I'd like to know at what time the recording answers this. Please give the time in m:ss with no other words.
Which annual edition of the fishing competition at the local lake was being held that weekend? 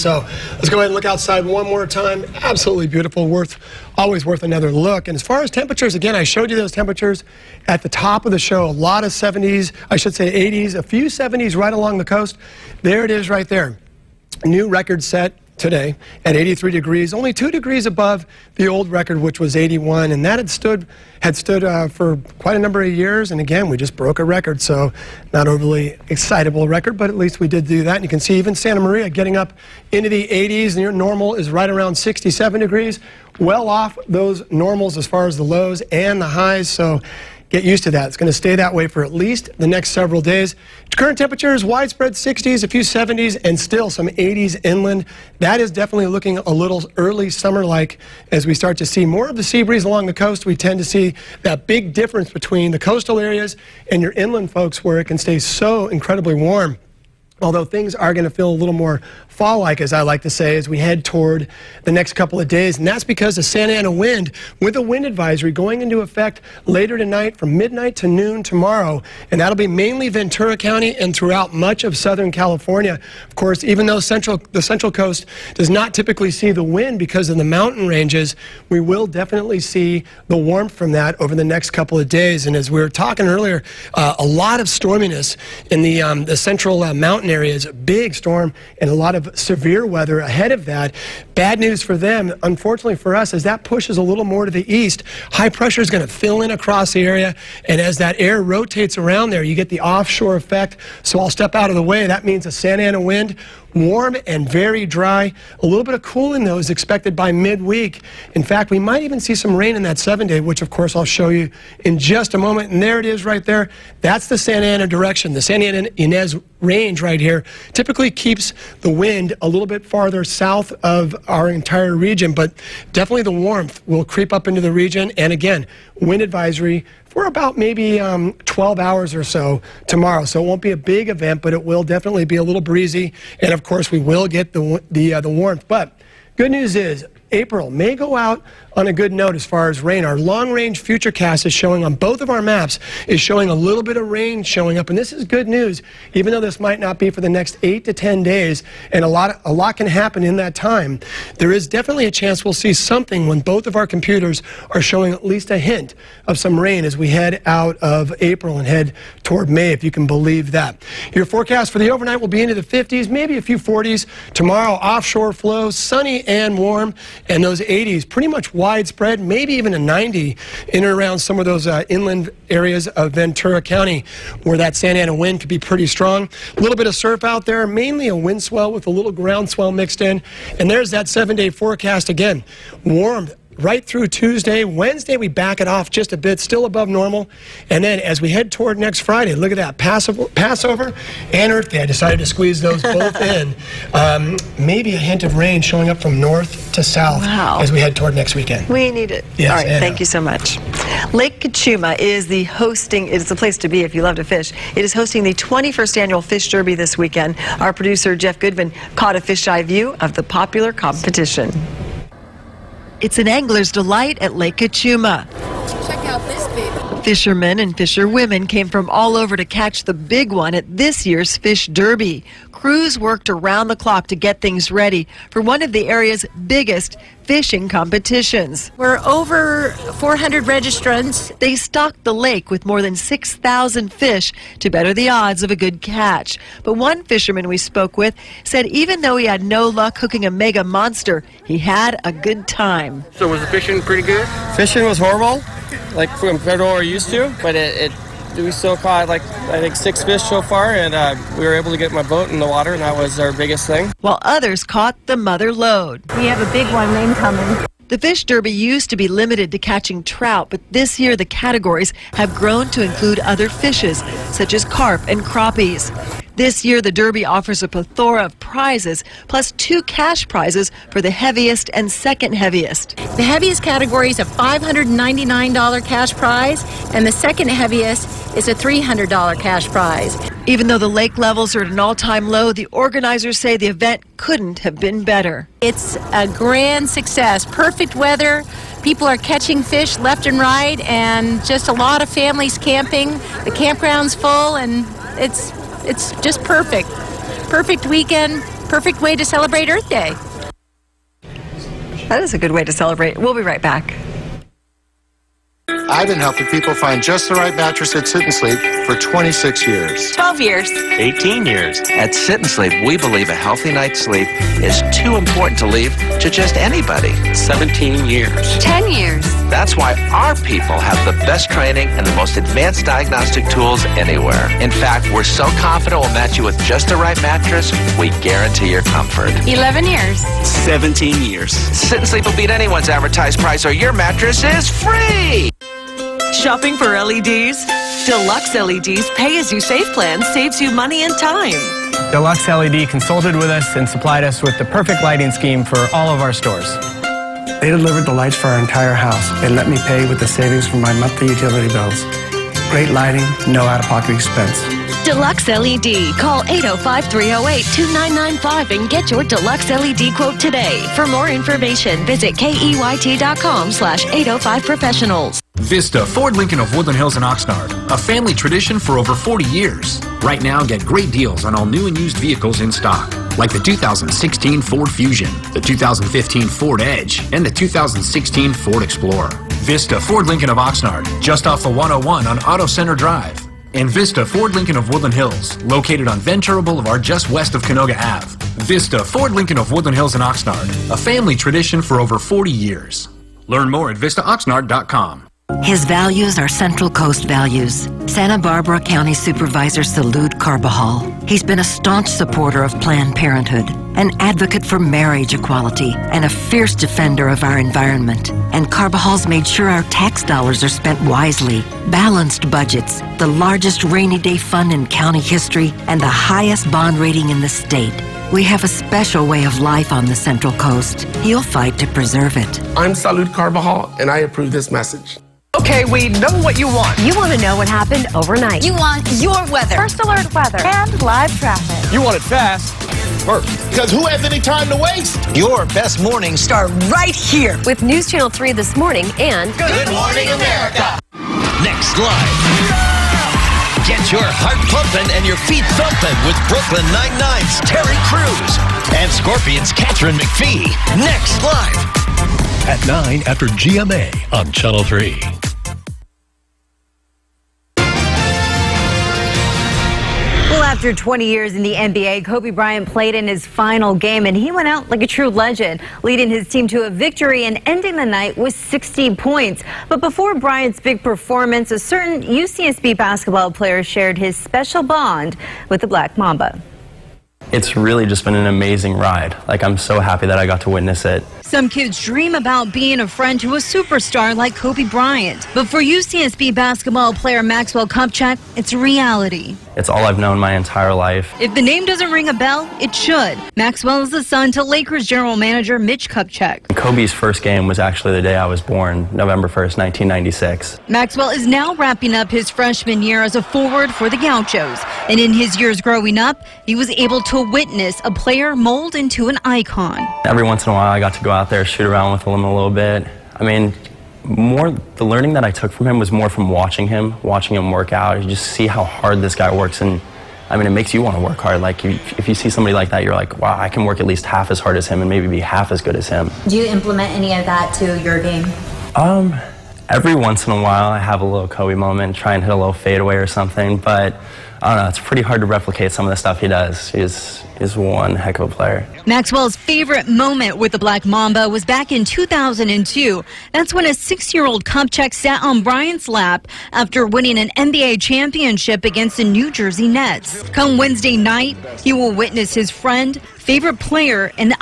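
3:25.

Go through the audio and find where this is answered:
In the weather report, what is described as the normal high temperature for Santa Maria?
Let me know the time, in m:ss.
0:31.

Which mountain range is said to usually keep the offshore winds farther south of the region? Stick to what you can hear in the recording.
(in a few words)
Santa Ana Inez range.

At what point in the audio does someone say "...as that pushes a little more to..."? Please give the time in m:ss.
1:33.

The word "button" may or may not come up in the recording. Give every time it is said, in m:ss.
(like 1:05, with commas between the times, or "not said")
not said.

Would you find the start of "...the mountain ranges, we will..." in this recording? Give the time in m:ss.
1:17.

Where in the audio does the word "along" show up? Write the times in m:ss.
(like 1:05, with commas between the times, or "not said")
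0:11, 0:49.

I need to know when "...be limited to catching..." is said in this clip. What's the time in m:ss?
4:18.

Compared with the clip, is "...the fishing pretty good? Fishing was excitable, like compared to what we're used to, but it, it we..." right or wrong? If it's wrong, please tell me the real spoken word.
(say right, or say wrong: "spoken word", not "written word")
wrong: "horrible", not "excitable".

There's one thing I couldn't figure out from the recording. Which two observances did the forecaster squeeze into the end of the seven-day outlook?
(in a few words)
Passover and Earth Day.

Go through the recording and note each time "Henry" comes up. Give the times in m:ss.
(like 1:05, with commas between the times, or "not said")
not said.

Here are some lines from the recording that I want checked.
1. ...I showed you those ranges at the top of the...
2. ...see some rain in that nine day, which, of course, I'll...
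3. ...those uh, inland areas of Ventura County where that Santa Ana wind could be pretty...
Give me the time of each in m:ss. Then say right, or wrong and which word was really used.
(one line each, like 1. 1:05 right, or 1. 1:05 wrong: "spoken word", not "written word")
1. 0:06 wrong: "temperatures", not "ranges"
2. 1:49 wrong: "seven", not "nine"
3. 2:51 right.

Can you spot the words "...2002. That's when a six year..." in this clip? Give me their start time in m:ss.
9:02.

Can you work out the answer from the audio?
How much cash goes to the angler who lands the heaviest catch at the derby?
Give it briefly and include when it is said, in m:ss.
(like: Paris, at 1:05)
$599, at 4:34.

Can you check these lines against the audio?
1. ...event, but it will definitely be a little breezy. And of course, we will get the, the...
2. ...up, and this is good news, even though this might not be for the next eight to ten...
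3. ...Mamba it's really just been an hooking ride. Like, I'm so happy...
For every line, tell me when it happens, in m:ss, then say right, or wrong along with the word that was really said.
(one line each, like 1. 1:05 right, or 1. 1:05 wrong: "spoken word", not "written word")
1. 2:11 right
2. 2:24 right
3. 7:56 wrong: "amazing", not "hooking".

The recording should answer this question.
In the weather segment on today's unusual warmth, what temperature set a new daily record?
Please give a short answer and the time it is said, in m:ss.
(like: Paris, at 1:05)
83 degrees, at 0:16.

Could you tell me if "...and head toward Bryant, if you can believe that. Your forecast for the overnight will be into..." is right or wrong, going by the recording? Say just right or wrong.
wrong.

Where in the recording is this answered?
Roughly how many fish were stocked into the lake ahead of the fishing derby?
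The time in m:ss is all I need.
3:52.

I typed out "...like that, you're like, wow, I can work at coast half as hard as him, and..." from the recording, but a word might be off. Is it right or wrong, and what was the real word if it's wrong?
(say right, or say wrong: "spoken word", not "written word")
wrong: "least", not "coast".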